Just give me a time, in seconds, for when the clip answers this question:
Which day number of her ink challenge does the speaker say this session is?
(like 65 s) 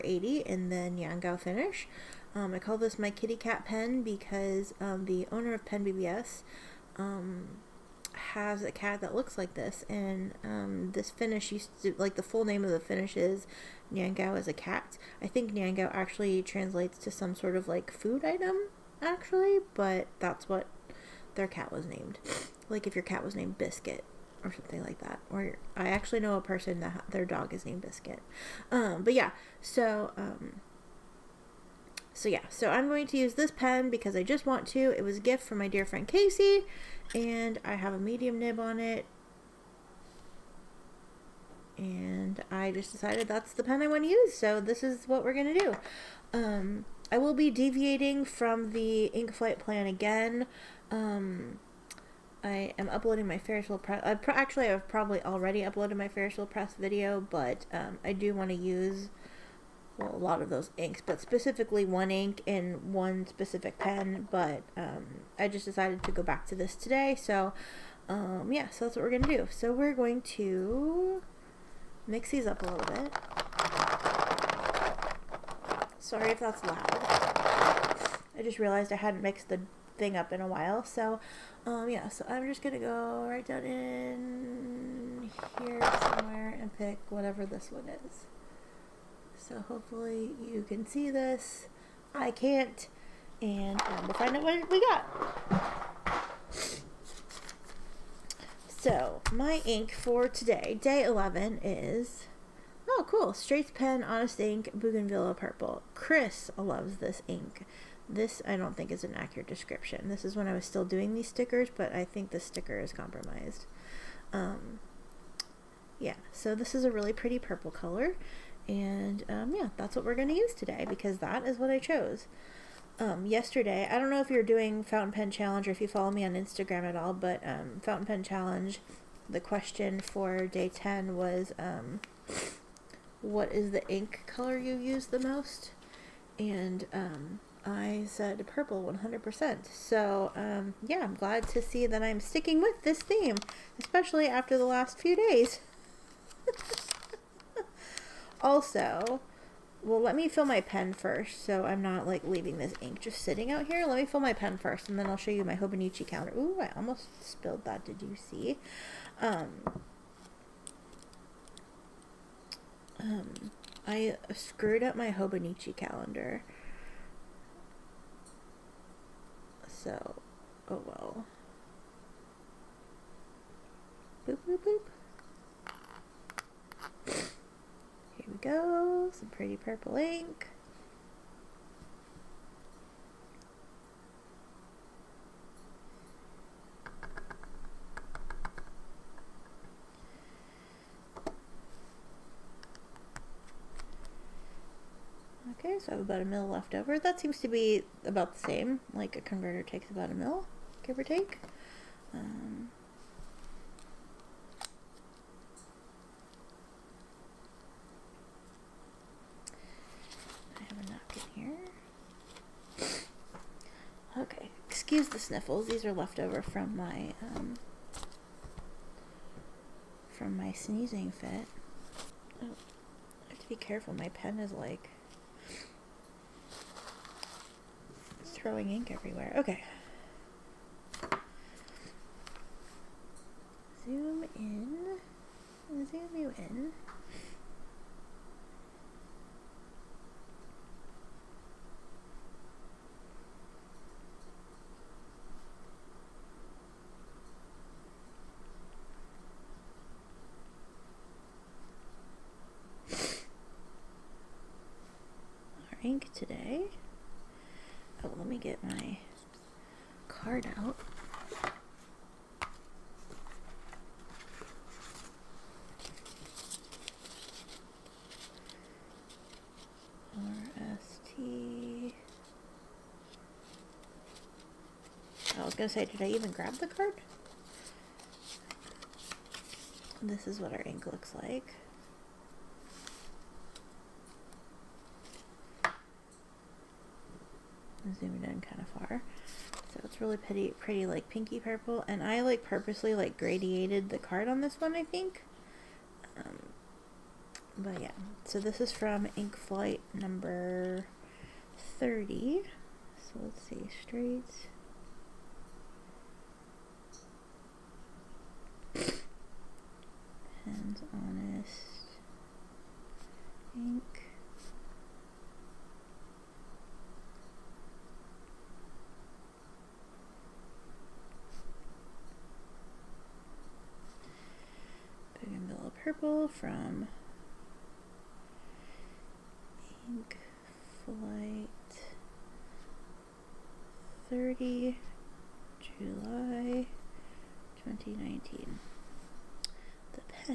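100 s.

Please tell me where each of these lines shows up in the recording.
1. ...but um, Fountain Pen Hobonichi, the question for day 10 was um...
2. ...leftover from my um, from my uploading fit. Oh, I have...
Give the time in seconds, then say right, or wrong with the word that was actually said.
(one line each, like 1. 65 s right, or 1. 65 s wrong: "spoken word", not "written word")
1. 127 s wrong: "Challenge", not "Hobonichi"
2. 215 s wrong: "sneezing", not "uploading".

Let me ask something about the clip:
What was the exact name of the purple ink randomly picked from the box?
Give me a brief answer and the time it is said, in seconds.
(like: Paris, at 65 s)
Bougainvillea Purple, at 104 s.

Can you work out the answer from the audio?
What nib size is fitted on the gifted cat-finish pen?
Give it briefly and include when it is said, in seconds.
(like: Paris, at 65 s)
Medium, at 37 s.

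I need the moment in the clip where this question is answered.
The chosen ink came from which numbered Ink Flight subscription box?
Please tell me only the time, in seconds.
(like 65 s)
299 s.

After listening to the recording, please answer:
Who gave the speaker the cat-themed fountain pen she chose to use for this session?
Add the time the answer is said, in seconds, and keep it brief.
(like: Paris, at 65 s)
Casey, at 36 s.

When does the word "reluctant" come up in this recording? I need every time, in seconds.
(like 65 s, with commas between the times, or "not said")
not said.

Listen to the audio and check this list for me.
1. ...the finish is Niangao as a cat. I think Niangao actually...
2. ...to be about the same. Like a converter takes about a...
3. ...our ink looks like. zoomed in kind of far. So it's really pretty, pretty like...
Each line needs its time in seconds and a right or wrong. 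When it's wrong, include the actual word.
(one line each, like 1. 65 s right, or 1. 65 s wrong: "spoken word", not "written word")
1. 12 s right
2. 197 s right
3. 280 s right.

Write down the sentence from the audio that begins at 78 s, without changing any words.
I just realized I hadn't mixed the thing up in a while.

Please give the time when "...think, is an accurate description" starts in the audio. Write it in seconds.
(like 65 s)
108 s.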